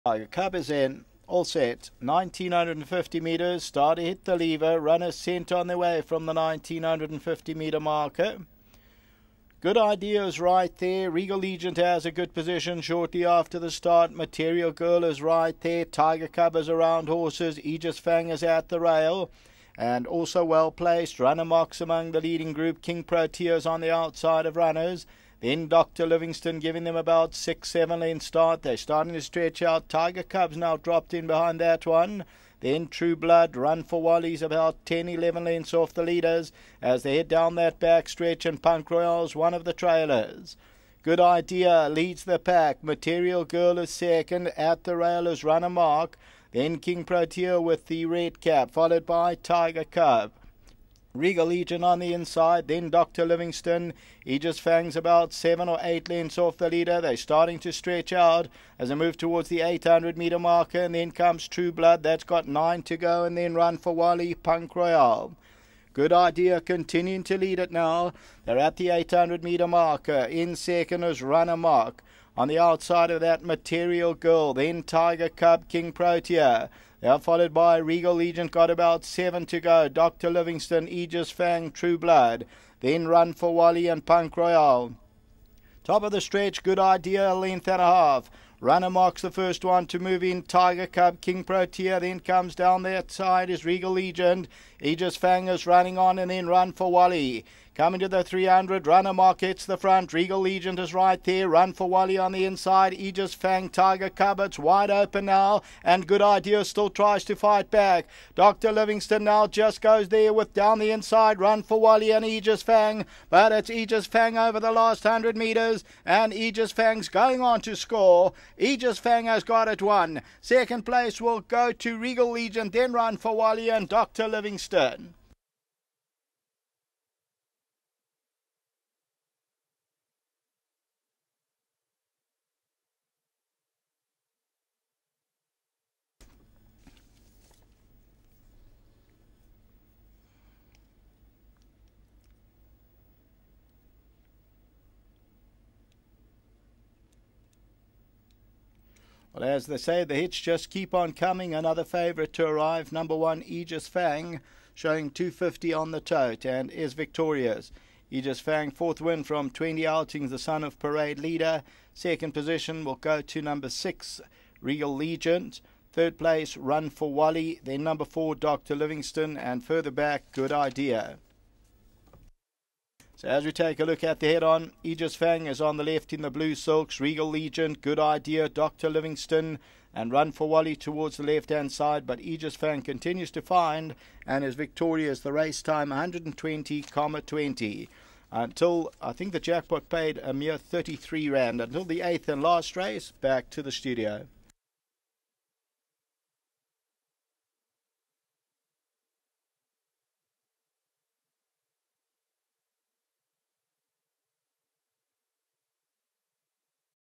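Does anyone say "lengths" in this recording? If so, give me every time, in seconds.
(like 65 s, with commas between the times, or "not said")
28 s, 35 s, 56 s, 87 s.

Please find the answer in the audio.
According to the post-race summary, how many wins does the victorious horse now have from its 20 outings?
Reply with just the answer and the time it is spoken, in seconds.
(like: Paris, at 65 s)
4, at 158 s.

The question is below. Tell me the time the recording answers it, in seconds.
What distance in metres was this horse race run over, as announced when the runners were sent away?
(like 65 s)
1 s.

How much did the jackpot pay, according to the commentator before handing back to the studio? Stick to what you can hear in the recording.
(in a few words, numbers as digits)
33 rand.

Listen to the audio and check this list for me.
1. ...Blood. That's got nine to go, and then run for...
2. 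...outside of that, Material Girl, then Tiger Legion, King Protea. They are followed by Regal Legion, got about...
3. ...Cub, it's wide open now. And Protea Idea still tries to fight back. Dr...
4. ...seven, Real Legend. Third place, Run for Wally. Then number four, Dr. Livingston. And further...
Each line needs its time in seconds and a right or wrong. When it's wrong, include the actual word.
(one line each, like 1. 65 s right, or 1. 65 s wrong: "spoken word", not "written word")
1. 61 s right
2. 72 s wrong: "Cub", not "Legion"
3. 104 s wrong: "Good", not "Protea"
4. 163 s wrong: "six", not "seven".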